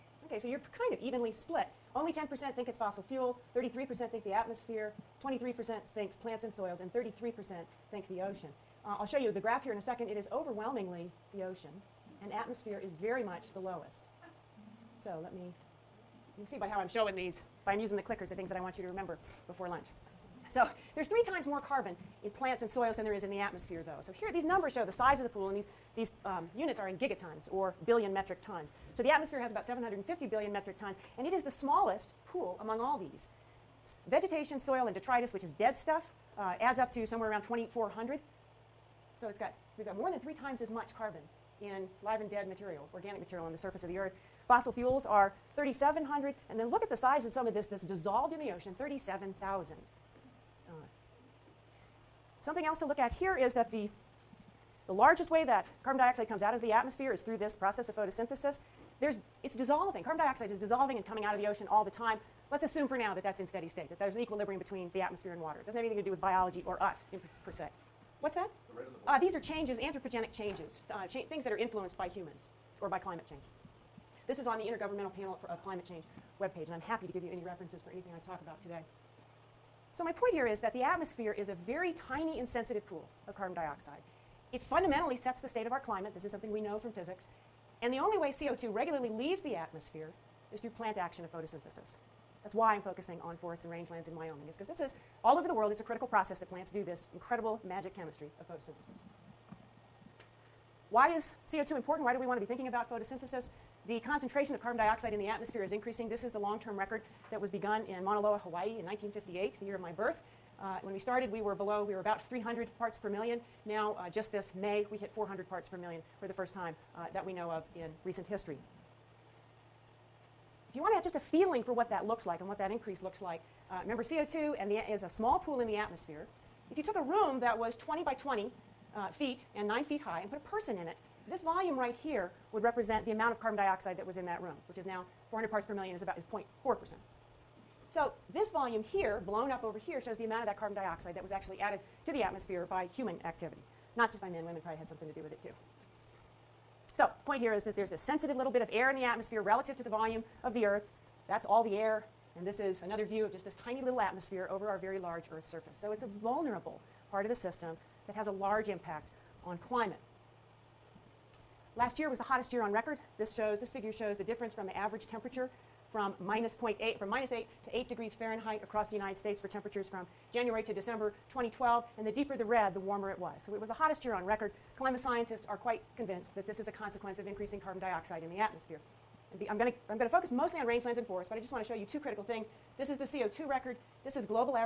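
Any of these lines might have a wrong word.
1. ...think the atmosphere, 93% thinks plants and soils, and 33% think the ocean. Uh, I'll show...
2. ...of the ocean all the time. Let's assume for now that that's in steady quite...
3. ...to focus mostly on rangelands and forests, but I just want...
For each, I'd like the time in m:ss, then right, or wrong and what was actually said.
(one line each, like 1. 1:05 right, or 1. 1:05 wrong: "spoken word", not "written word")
1. 0:04 wrong: "23", not "93"
2. 1:01 wrong: "state", not "quite"
3. 2:59 right.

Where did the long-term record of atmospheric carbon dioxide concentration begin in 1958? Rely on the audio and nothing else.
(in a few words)
Mauna Loa, Hawaii.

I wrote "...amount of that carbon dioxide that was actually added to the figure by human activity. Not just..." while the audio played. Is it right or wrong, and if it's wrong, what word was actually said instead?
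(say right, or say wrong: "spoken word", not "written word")
wrong: "atmosphere", not "figure".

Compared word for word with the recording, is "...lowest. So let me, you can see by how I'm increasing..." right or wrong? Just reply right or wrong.
wrong.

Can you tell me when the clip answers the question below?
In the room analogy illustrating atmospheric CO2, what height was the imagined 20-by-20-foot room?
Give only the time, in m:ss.
2:09.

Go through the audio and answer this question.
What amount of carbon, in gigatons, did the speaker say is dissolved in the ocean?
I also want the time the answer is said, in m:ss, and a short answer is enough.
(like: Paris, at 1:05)
37,000, at 0:48.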